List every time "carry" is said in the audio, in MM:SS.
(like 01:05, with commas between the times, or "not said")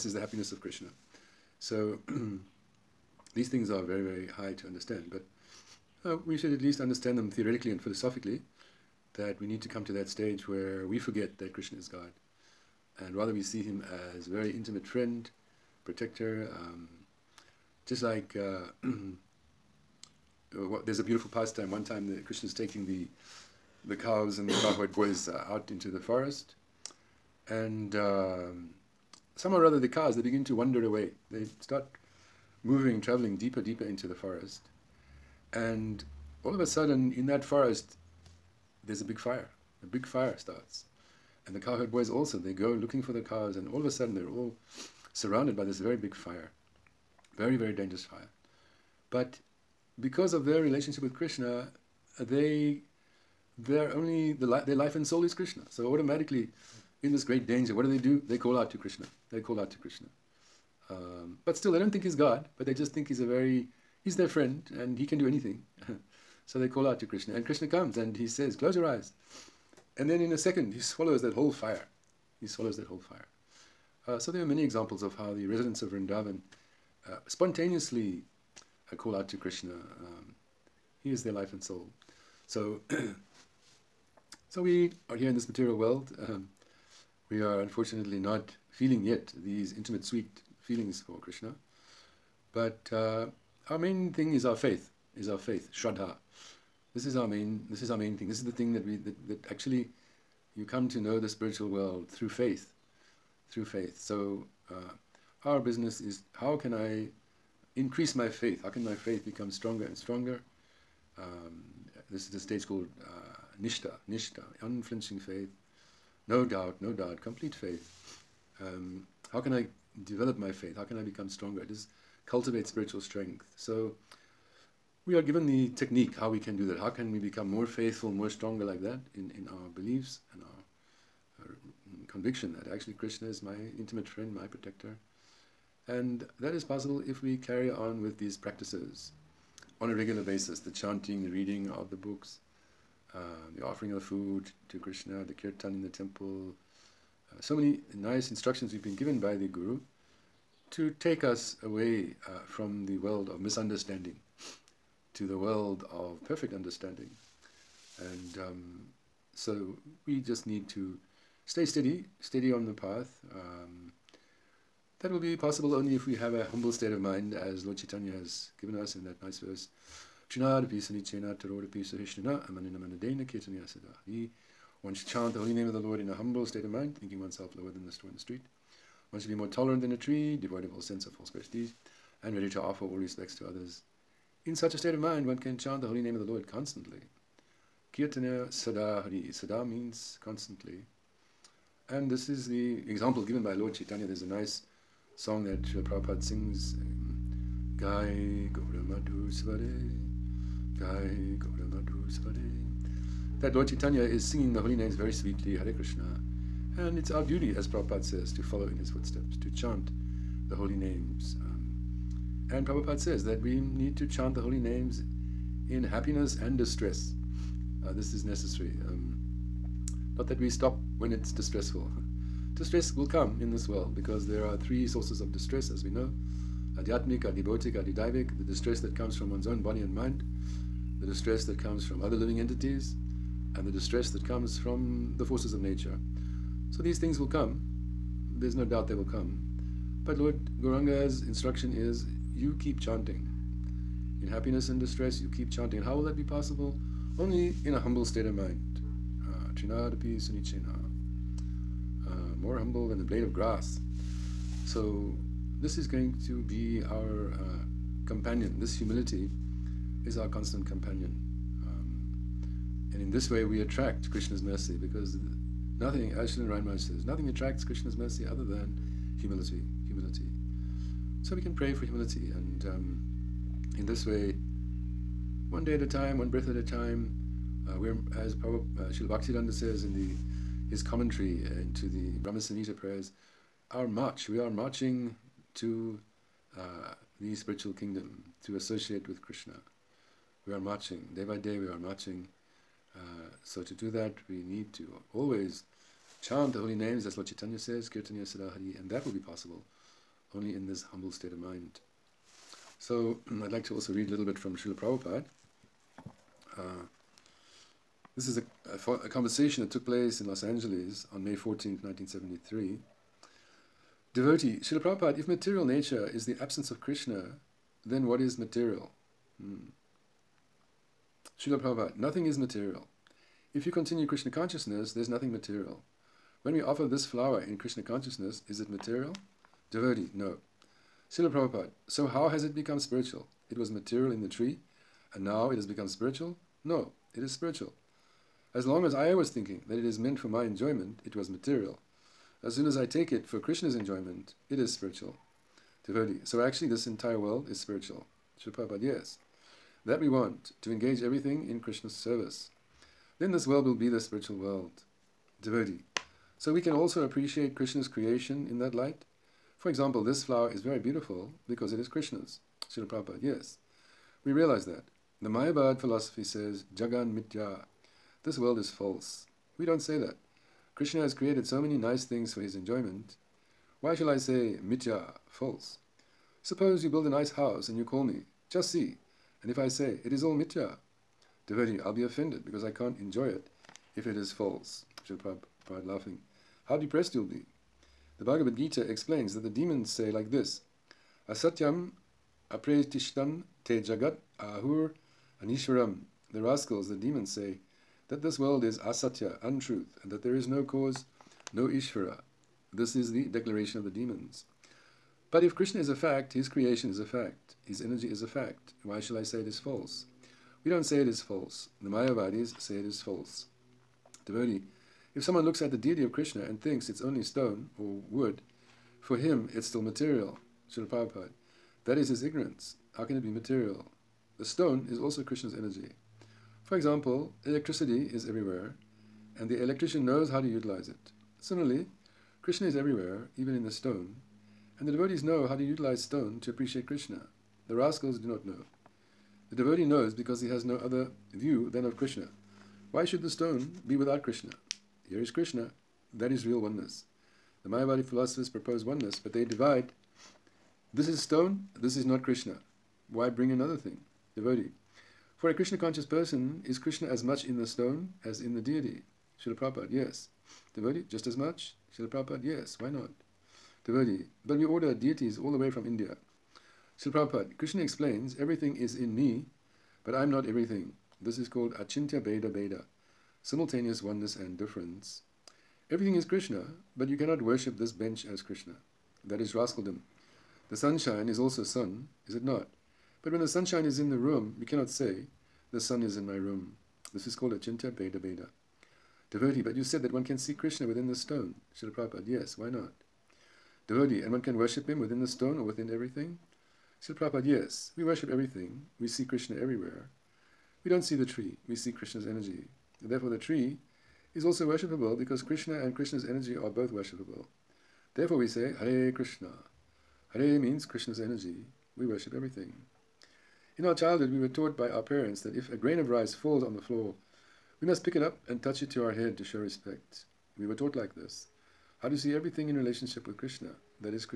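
02:17.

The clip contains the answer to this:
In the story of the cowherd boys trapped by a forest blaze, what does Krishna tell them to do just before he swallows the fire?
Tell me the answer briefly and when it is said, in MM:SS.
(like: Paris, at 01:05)
Close your eyes, at 01:08.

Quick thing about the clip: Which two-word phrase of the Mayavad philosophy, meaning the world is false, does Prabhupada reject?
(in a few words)
Jagan Mithya.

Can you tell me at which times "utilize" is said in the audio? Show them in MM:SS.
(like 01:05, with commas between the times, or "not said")
07:10, 07:15.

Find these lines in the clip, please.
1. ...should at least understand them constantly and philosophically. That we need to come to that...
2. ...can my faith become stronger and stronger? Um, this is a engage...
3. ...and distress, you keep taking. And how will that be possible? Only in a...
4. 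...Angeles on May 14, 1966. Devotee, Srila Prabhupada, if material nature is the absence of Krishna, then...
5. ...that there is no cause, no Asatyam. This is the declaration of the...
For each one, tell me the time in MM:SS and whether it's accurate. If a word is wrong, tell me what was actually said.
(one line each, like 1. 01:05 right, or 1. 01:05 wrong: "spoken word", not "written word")
1. 00:06 wrong: "theoretically", not "constantly"
2. 01:48 wrong: "stage", not "engage"
3. 04:04 wrong: "chanting", not "taking"
4. 05:10 wrong: "1973", not "1966"
5. 06:40 wrong: "Ishvara", not "Asatyam".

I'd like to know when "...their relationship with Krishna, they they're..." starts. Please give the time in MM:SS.
00:50.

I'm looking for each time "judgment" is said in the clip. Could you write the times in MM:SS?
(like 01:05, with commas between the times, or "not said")
not said.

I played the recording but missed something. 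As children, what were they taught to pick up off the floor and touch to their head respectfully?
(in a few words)
A grain of rice.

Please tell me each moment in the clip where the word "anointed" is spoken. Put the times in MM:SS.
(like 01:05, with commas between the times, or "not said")
not said.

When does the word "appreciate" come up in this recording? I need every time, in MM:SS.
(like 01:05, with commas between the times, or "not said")
05:57, 07:16.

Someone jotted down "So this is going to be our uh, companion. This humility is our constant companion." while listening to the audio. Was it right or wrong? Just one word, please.
right.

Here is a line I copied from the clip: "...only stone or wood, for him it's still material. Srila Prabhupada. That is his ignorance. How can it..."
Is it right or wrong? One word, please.
right.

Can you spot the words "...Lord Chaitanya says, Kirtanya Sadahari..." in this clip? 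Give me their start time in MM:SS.
04:57.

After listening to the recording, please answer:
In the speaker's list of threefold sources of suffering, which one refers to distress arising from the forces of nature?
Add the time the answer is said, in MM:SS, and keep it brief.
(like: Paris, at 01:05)
Adidaivik, at 03:47.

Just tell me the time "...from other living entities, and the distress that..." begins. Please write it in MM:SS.
03:51.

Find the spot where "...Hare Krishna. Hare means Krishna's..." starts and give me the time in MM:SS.
08:28.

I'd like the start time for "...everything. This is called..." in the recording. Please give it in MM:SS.
07:50.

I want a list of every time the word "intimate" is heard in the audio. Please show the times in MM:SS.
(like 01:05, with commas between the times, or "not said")
00:14, 01:29, 02:13.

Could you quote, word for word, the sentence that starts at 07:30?
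This is stone, this is not Krishna.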